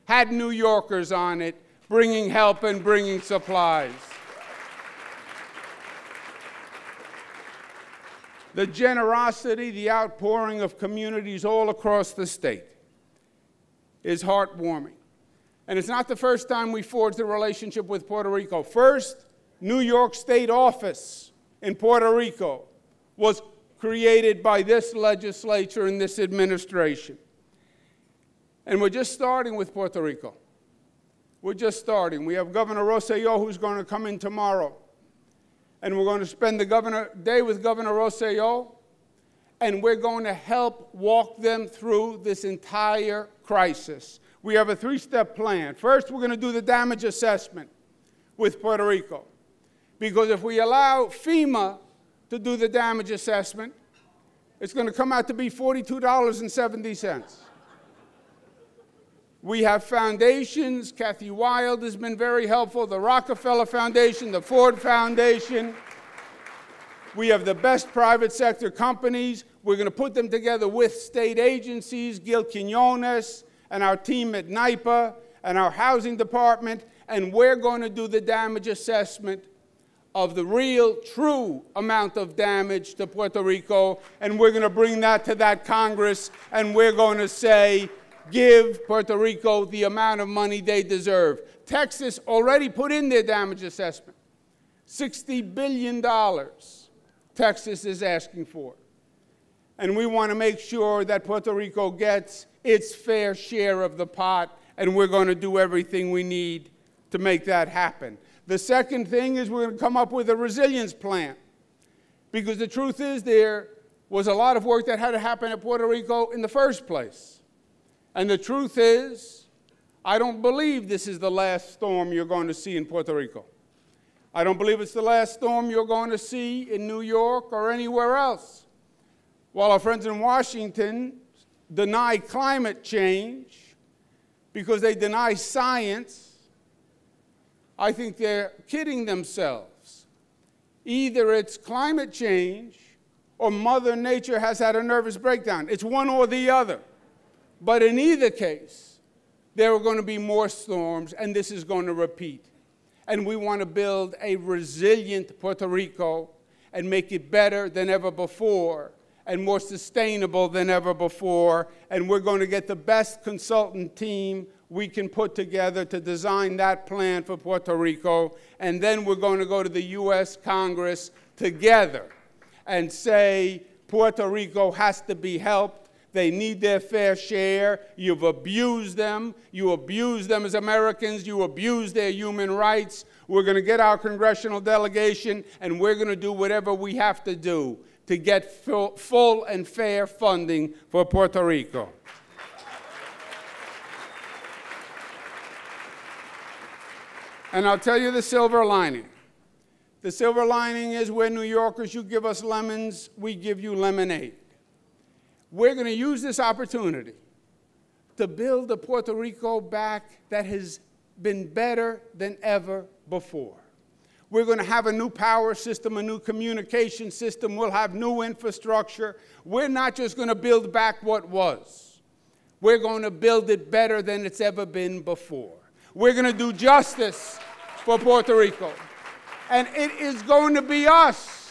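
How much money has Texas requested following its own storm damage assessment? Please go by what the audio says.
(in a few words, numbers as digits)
$60 billion.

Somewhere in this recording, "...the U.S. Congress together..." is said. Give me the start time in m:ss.
2:49.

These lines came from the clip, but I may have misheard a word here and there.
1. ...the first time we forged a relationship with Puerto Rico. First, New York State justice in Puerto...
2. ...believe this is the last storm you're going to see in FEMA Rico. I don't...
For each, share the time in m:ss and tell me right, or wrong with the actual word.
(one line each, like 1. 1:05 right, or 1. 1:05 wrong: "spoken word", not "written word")
1. 0:16 wrong: "office", not "justice"
2. 2:00 wrong: "Puerto", not "FEMA".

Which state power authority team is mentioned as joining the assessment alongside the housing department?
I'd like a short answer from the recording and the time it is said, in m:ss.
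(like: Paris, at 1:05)
NYPA, at 1:14.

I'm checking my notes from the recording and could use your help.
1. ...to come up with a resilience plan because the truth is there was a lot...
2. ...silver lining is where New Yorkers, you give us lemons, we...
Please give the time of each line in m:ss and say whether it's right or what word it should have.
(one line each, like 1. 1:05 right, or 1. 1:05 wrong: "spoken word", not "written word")
1. 1:49 right
2. 3:20 right.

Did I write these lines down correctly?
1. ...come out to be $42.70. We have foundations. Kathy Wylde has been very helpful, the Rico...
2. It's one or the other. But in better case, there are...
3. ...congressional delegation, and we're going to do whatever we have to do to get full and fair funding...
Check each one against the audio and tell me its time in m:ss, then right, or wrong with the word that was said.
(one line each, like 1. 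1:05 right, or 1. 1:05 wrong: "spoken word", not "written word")
1. 0:54 wrong: "Rockefeller", not "Rico"
2. 2:25 wrong: "either", not "better"
3. 3:03 right.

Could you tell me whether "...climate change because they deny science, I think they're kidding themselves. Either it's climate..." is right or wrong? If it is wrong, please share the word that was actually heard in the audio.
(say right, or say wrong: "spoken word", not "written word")
right.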